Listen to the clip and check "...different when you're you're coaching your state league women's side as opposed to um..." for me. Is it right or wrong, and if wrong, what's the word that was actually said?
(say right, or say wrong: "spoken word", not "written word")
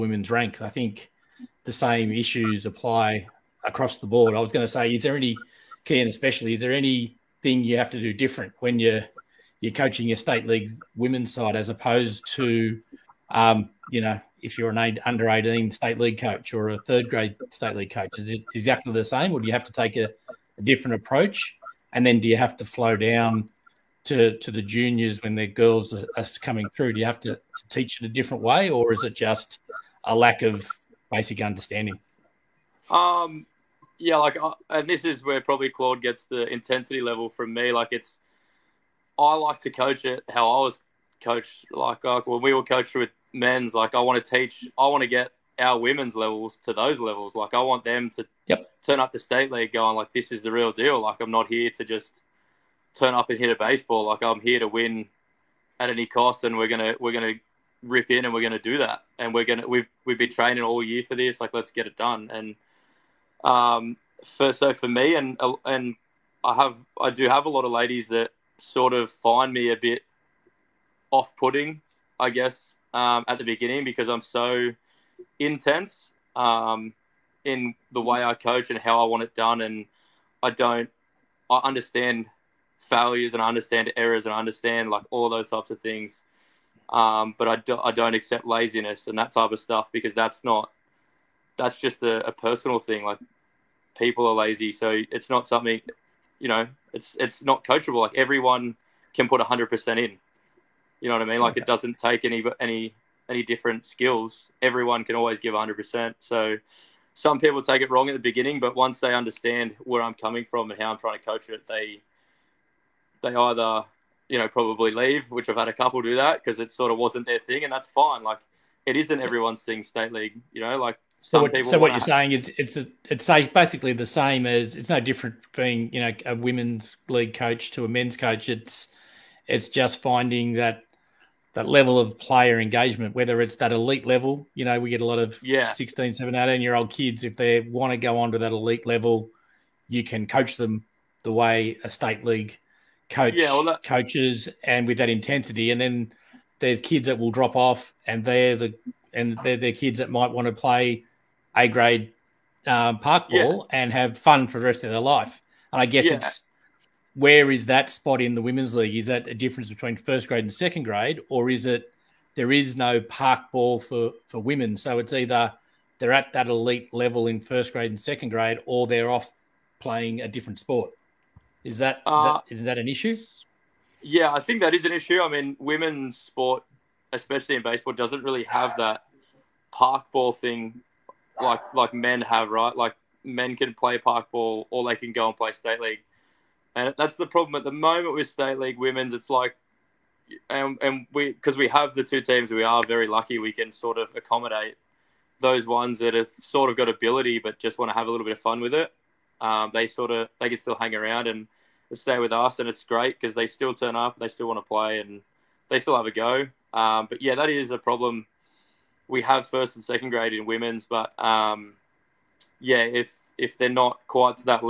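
right.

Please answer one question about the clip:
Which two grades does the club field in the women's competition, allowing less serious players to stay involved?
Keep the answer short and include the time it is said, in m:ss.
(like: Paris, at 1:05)
First and second grade, at 3:29.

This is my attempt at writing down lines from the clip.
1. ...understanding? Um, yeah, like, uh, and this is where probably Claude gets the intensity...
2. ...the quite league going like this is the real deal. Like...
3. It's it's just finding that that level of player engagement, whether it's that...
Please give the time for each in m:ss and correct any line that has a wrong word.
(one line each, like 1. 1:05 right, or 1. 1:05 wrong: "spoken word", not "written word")
1. 0:31 right
2. 0:49 wrong: "state", not "quite"
3. 2:08 right.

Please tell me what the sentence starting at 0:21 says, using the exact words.
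And then do you have to flow down to, to the juniors when their girls are, are coming through?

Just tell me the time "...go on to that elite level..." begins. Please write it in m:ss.
2:17.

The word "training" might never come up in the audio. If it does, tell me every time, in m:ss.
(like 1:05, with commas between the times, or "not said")
1:00.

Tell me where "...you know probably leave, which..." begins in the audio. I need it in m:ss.
1:54.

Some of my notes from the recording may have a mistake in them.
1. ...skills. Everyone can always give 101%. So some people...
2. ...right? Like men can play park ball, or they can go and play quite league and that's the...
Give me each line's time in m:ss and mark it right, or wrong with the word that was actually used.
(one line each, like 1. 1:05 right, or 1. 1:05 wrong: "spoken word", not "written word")
1. 1:43 wrong: "100", not "101"
2. 3:02 wrong: "state", not "quite".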